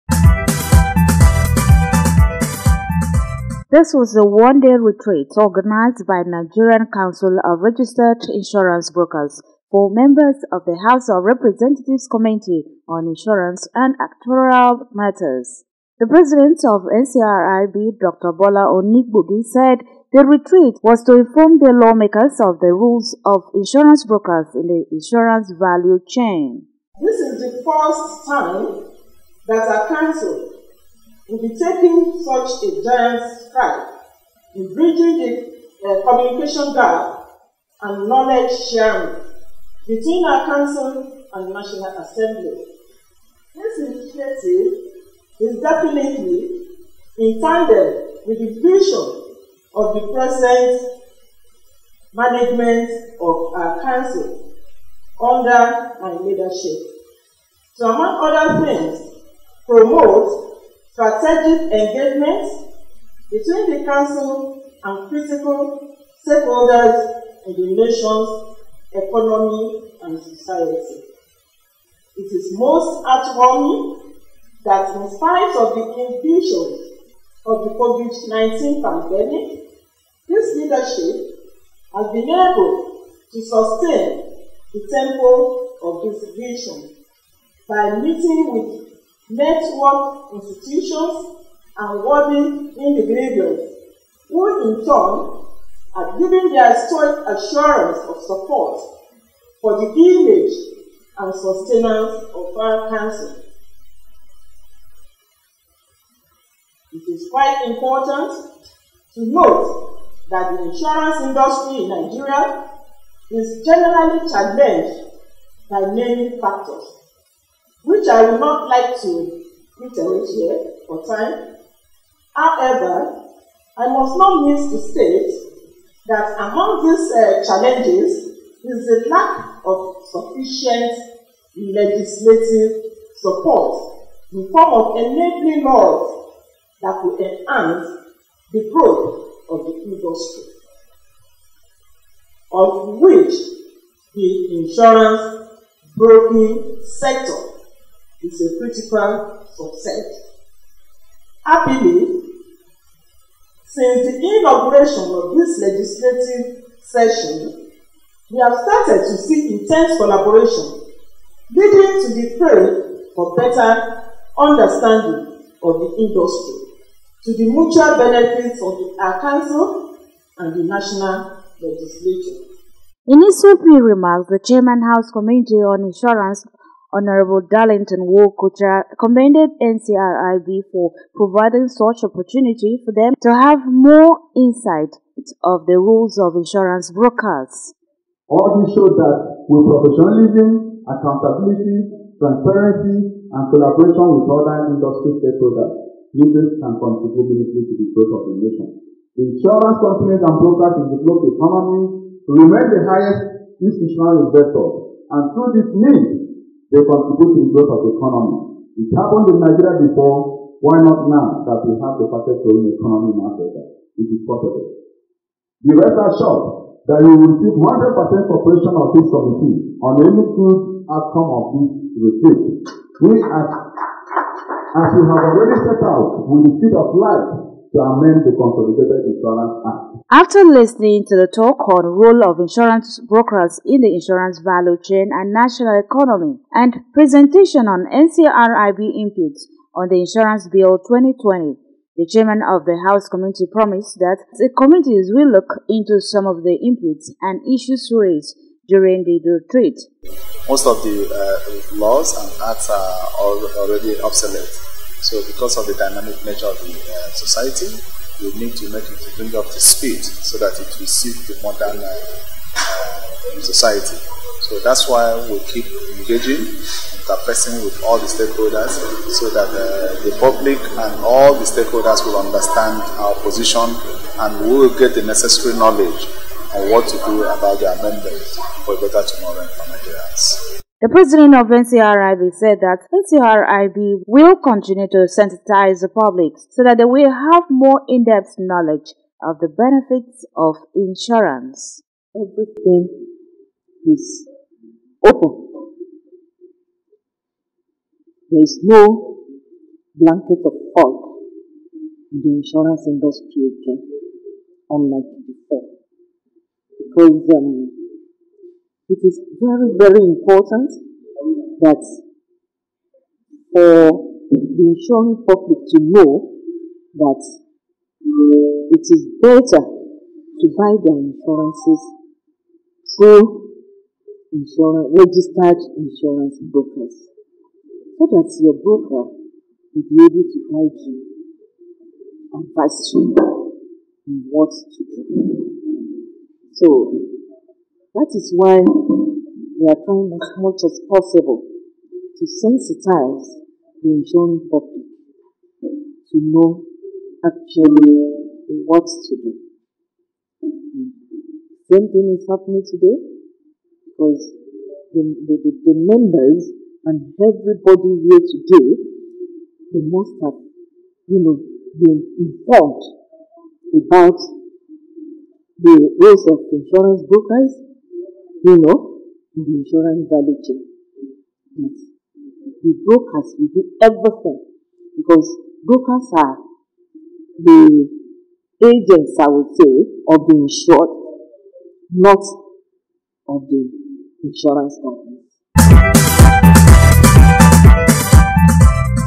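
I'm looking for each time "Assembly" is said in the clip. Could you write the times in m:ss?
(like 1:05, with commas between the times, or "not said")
0:41.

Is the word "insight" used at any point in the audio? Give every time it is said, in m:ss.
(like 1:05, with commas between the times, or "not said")
3:04.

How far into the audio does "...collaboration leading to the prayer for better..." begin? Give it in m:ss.
2:39.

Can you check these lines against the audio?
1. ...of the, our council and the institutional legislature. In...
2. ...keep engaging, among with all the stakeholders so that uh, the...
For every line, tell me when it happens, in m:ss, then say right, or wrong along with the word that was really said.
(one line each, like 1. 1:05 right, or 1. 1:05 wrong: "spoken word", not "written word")
1. 2:48 wrong: "national", not "institutional"
2. 4:25 wrong: "interfacing", not "among".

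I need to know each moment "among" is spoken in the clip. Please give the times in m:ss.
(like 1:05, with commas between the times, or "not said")
0:57, 2:06.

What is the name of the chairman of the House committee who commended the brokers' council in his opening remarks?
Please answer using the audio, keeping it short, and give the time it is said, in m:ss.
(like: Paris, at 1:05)
Darlington Nwokocha, at 2:57.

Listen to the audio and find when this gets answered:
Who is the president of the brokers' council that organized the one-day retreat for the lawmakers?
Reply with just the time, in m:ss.
0:17.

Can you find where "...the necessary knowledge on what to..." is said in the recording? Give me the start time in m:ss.
4:34.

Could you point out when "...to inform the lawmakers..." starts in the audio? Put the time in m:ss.
0:21.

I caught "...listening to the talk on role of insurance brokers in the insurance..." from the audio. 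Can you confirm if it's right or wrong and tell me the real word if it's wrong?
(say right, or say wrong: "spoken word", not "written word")
right.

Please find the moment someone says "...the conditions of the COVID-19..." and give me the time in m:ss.
1:15.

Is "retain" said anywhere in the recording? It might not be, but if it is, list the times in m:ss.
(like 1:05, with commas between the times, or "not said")
not said.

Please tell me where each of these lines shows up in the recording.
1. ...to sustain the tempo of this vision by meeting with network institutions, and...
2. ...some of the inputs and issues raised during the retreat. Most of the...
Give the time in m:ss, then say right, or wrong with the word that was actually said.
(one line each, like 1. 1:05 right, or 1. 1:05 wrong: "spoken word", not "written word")
1. 1:23 right
2. 4:06 right.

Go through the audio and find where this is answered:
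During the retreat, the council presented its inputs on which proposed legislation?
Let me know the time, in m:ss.
4:00.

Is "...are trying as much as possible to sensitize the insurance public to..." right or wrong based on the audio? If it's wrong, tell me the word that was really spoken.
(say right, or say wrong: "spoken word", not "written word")
right.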